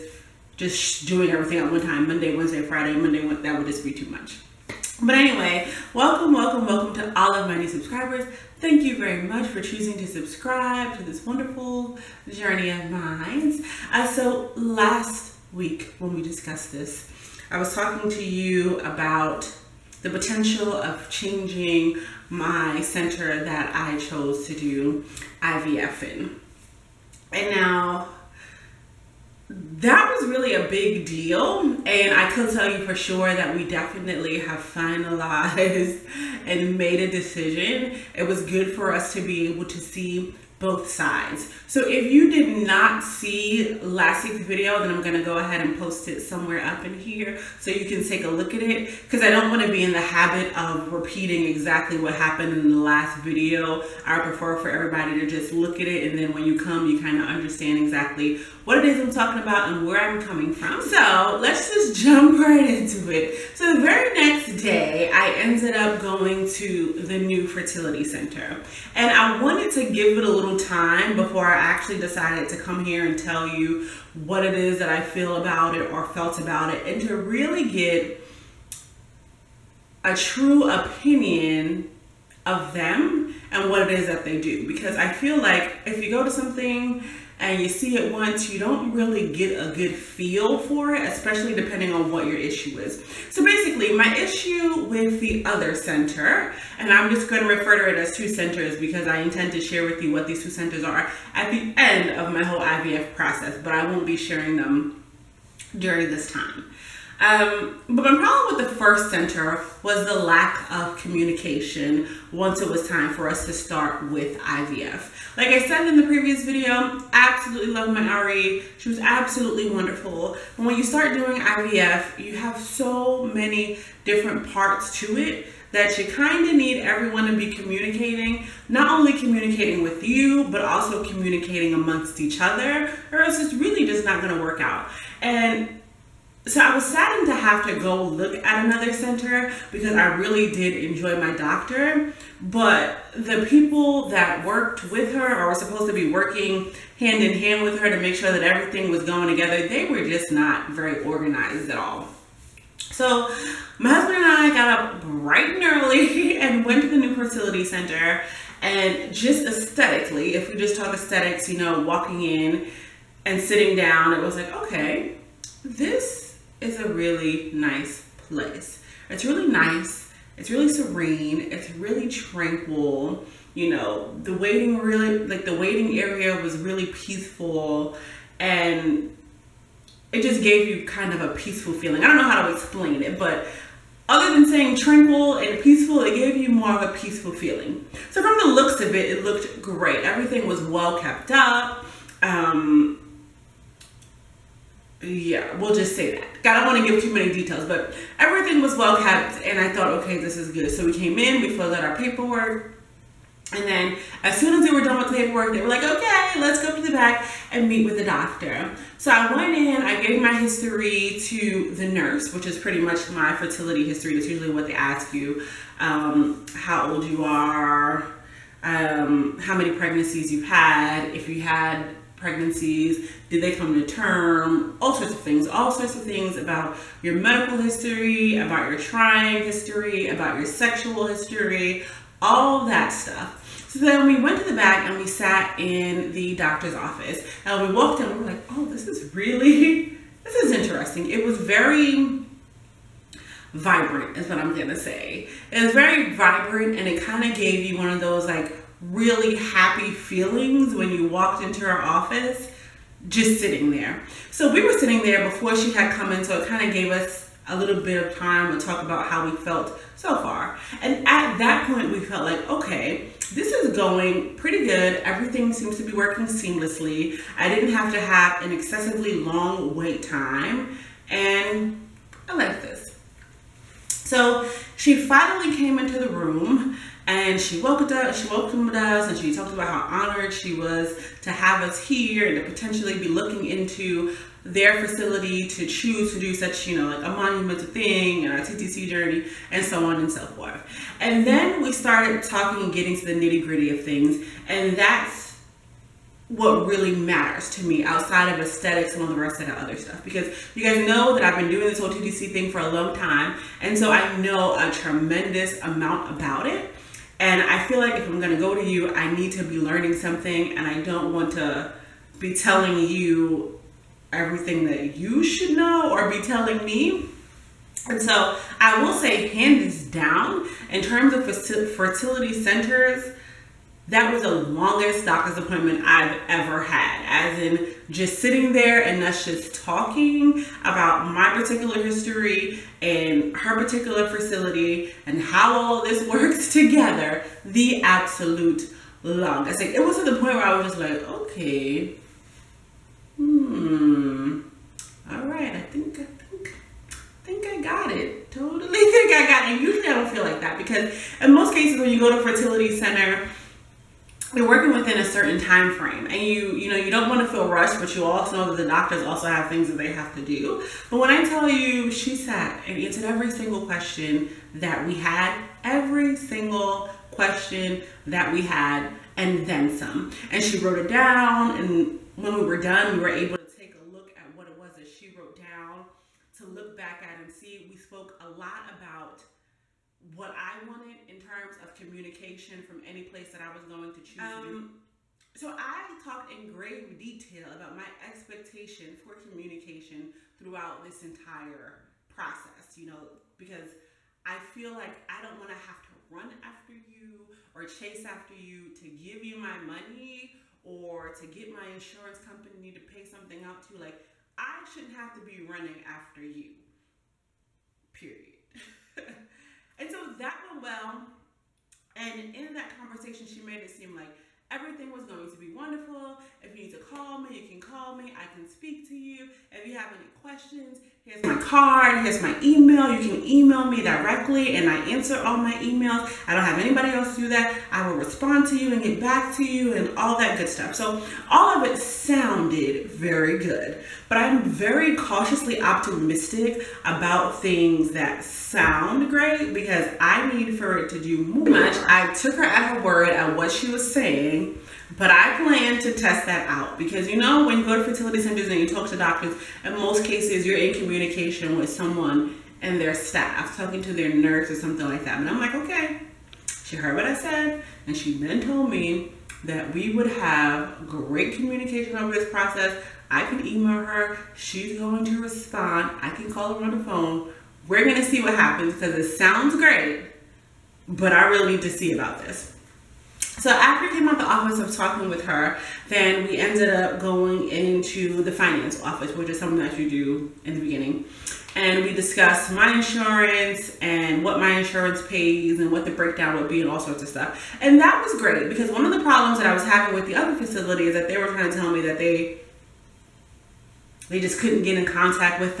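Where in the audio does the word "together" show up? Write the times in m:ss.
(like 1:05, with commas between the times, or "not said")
2:29, 5:36.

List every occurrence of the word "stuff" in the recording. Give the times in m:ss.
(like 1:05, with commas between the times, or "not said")
3:52, 4:59, 7:10, 8:07.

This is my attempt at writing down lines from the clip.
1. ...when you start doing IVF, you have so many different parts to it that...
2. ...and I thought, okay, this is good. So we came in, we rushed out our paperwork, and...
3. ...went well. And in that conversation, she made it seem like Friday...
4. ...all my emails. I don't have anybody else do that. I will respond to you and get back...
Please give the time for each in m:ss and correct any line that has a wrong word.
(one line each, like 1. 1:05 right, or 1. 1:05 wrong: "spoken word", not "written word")
1. 2:00 right
2. 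3:19 wrong: "filled", not "rushed"
3. 6:50 wrong: "Everything", not "Friday"
4. 7:05 right.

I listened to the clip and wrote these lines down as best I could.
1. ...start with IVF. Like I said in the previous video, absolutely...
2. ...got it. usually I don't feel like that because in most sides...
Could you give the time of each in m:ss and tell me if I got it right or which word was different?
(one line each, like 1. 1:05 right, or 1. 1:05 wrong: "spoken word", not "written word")
1. 1:53 right
2. 5:49 wrong: "cases", not "sides".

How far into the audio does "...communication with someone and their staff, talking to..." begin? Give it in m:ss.
7:30.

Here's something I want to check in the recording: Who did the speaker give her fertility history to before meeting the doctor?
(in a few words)
the nurse.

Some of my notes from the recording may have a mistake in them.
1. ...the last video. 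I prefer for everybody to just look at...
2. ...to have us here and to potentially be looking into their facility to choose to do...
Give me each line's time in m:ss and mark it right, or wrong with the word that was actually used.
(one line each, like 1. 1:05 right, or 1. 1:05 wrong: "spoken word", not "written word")
1. 0:52 right
2. 4:41 right.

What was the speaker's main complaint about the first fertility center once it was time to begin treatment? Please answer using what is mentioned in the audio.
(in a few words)
lack of communication.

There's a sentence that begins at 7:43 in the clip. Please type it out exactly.
I can email her, she's going to respond.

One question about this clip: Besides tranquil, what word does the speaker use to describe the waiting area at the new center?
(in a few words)
serene.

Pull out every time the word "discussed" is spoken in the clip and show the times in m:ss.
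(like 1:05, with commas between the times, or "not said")
0:16, 8:01.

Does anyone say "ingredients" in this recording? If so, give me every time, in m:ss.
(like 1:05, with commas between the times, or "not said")
not said.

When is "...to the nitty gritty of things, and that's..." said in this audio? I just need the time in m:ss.
4:52.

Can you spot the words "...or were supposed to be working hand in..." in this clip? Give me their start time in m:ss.
2:25.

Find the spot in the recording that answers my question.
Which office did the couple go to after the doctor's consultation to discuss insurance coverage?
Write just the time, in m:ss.
7:58.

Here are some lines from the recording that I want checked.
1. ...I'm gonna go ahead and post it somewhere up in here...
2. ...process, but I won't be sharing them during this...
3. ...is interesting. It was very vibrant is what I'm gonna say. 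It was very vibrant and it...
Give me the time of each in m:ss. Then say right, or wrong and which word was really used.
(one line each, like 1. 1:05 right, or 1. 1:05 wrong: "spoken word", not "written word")
1. 0:44 right
2. 1:43 right
3. 4:00 right.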